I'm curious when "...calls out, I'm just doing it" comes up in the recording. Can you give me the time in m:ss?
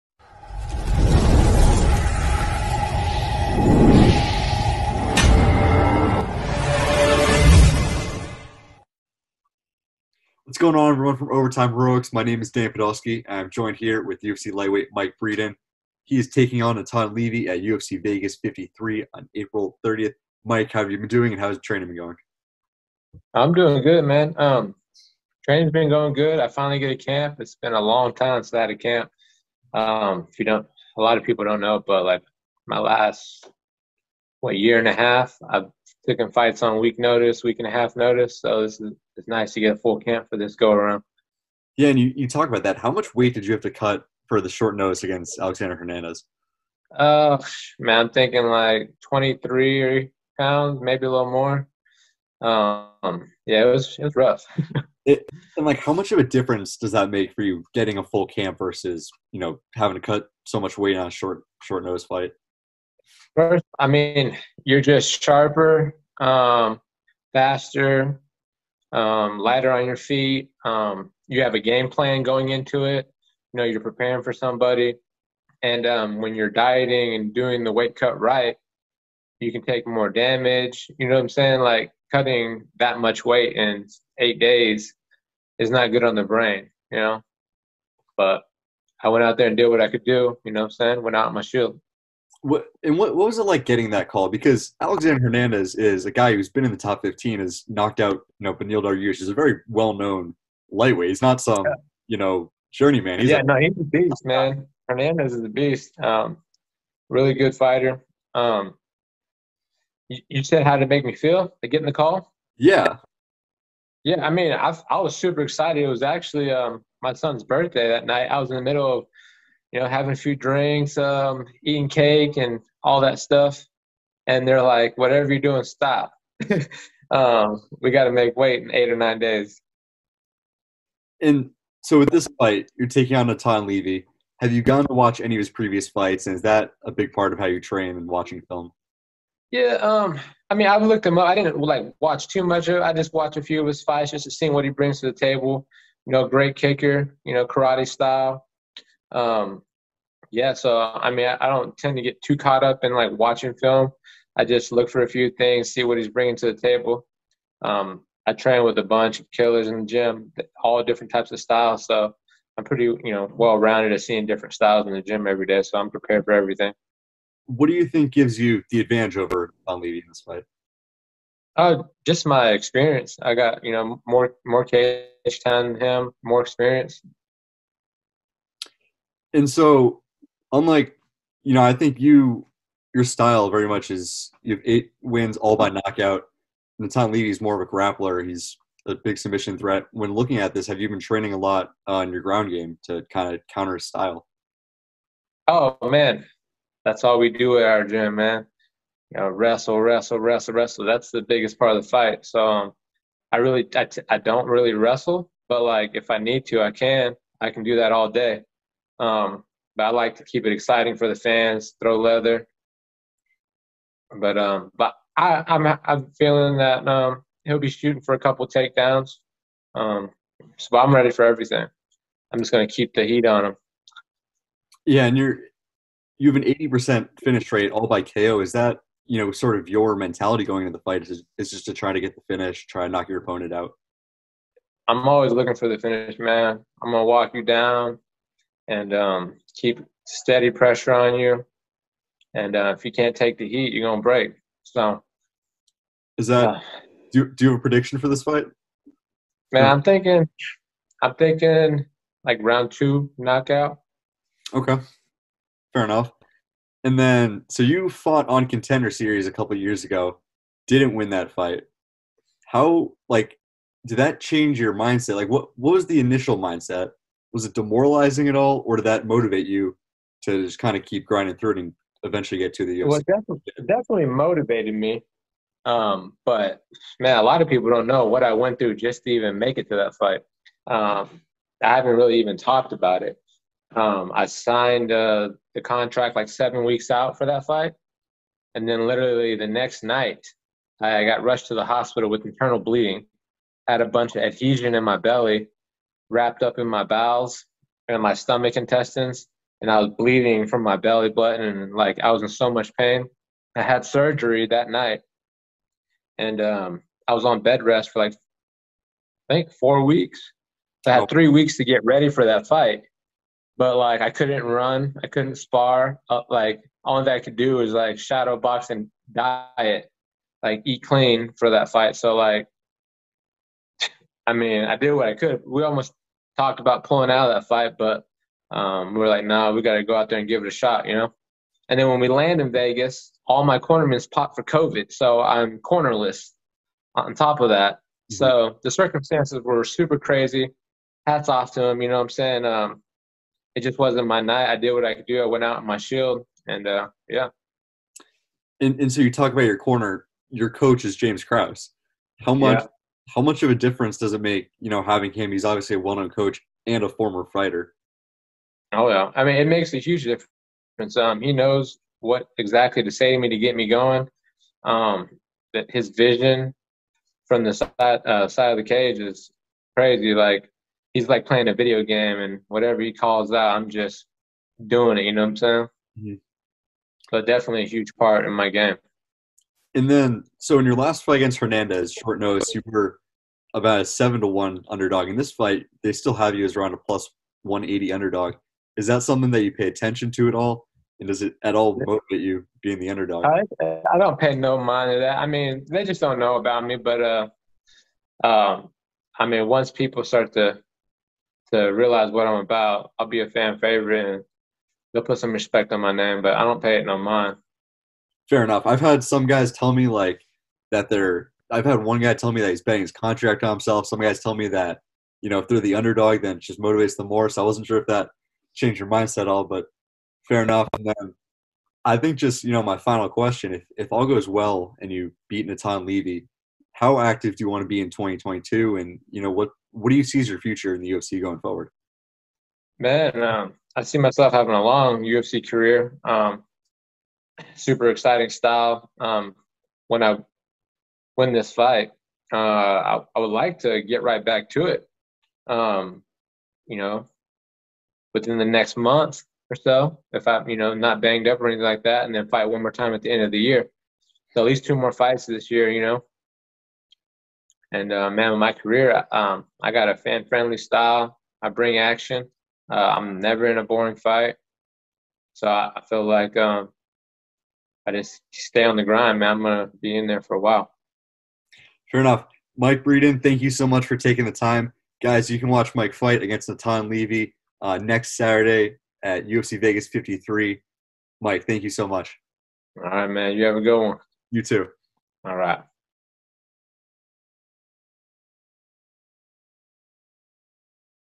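6:12.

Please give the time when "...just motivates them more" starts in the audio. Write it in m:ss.
6:56.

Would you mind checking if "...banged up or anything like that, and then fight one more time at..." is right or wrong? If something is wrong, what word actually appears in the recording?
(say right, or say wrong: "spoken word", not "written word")
right.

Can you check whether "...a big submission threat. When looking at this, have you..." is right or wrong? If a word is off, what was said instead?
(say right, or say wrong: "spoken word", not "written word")
right.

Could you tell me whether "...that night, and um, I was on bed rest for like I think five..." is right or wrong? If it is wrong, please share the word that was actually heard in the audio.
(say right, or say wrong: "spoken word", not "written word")
wrong: "four", not "five".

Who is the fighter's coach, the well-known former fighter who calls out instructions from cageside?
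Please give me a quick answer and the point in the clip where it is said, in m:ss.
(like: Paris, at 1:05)
James Krause, at 5:50.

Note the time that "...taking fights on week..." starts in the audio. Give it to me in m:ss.
0:36.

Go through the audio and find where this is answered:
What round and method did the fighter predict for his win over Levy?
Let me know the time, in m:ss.
4:12.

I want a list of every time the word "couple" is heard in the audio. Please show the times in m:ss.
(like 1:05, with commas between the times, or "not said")
3:38, 4:19.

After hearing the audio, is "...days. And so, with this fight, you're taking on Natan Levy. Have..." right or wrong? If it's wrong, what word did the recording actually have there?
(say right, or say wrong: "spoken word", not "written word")
right.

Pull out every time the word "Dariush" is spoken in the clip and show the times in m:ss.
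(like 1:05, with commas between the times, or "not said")
1:38.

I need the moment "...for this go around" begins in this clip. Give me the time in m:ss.
0:40.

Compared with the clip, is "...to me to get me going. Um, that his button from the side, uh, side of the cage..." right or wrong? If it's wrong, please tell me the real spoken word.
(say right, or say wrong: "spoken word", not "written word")
wrong: "vision", not "button".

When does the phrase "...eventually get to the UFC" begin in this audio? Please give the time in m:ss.
4:32.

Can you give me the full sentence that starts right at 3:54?
I'm always looking for the finish, man.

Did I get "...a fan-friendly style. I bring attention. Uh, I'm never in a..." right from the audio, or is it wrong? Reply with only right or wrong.
wrong.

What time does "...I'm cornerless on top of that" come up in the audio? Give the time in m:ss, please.
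5:35.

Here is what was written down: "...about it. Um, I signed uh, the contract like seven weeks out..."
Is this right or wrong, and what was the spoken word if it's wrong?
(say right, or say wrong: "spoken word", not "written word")
right.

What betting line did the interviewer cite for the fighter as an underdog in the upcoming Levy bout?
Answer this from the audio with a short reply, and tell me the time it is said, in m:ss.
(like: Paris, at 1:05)
+180, at 6:26.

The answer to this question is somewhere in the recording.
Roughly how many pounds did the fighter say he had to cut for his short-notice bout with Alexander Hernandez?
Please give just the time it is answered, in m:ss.
0:49.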